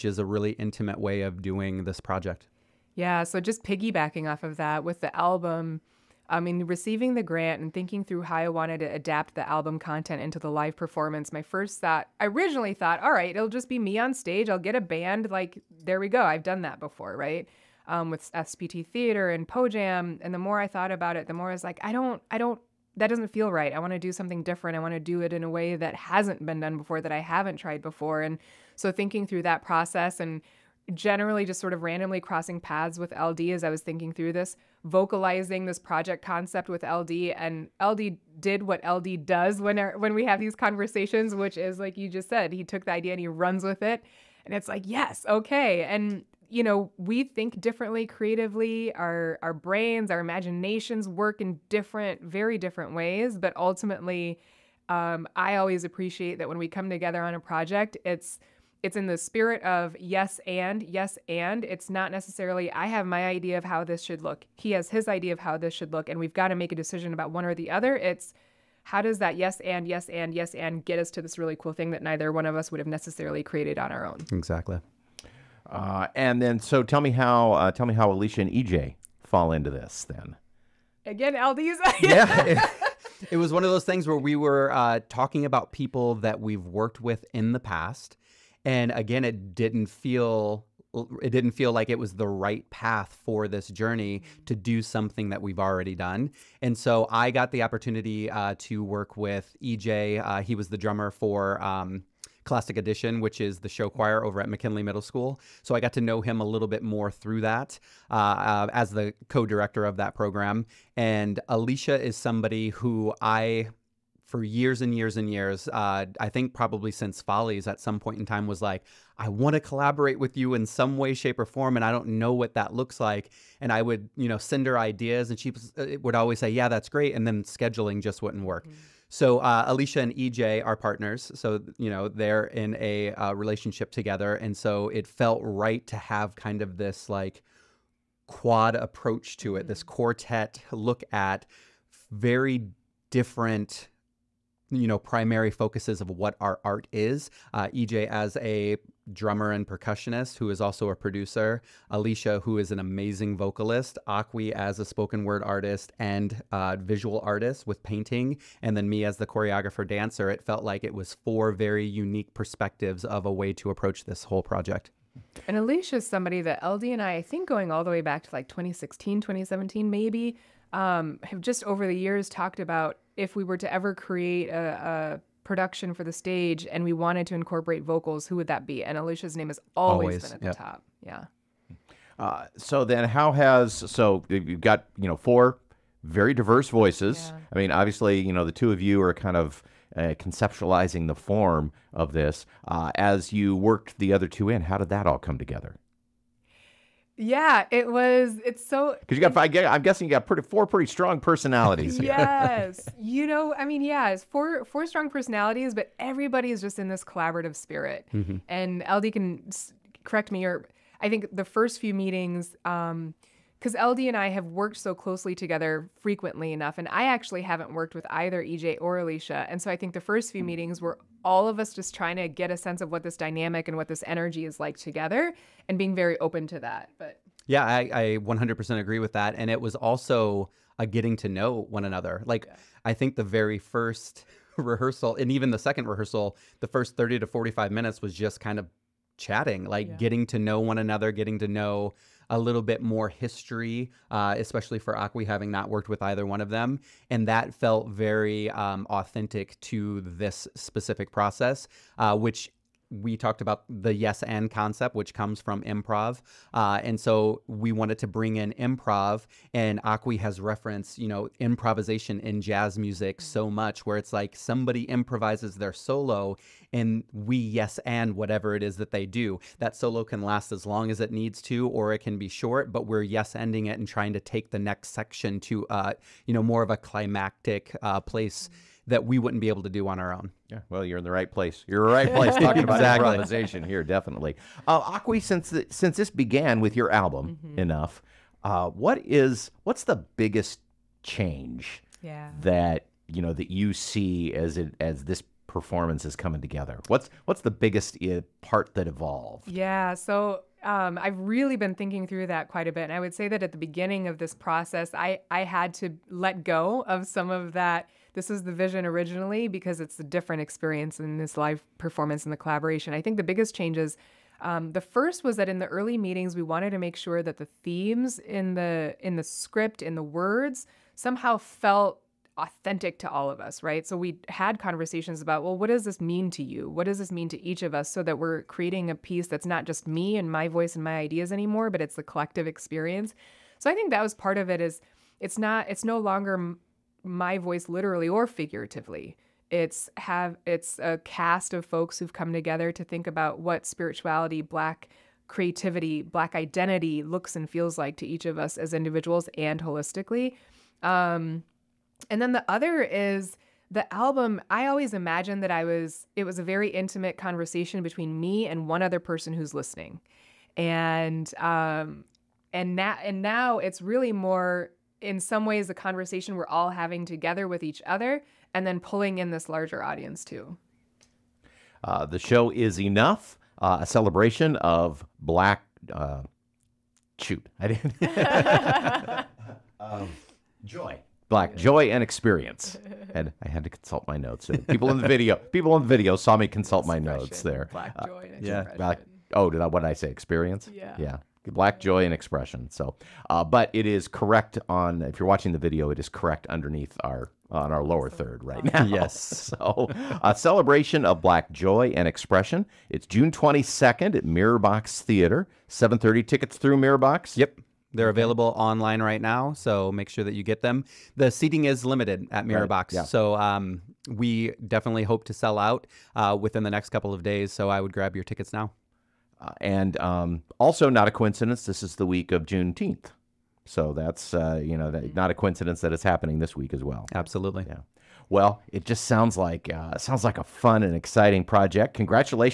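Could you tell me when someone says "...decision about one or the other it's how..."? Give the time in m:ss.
1:06.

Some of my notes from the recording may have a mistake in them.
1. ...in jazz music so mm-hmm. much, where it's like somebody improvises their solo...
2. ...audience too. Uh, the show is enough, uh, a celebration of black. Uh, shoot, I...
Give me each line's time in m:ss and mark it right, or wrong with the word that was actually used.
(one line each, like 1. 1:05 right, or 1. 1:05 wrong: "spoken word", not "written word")
1. 4:22 right
2. 6:09 right.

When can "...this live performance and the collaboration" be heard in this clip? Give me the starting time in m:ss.
5:11.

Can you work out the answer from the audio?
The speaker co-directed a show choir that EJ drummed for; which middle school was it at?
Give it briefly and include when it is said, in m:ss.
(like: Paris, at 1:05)
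McKinley Middle School, at 1:44.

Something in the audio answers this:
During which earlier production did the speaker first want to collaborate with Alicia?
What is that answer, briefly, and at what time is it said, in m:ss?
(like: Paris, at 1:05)
Follies, at 1:57.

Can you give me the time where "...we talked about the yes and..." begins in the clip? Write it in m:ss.
4:12.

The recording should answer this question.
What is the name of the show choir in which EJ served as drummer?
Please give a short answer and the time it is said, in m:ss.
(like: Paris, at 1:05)
Classic Edition, at 1:42.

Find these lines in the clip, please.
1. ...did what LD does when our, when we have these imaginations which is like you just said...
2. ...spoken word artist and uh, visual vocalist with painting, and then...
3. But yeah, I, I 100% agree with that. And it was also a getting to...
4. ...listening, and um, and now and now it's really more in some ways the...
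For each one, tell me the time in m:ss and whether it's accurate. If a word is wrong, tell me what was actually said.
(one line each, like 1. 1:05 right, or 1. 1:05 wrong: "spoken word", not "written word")
1. 0:38 wrong: "conversations", not "imaginations"
2. 2:34 wrong: "artist", not "vocalist"
3. 3:46 right
4. 5:59 right.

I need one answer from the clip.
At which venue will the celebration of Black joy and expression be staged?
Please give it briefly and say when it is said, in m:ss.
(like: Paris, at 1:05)
Mirrorbox Theater, at 6:44.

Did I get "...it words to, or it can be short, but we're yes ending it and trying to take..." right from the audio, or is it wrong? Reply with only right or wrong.
wrong.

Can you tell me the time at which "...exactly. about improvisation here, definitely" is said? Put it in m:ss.
4:42.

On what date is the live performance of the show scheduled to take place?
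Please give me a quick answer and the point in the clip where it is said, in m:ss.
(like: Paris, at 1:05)
June 22nd, at 6:43.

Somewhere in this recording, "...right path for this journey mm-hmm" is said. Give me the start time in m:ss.
1:32.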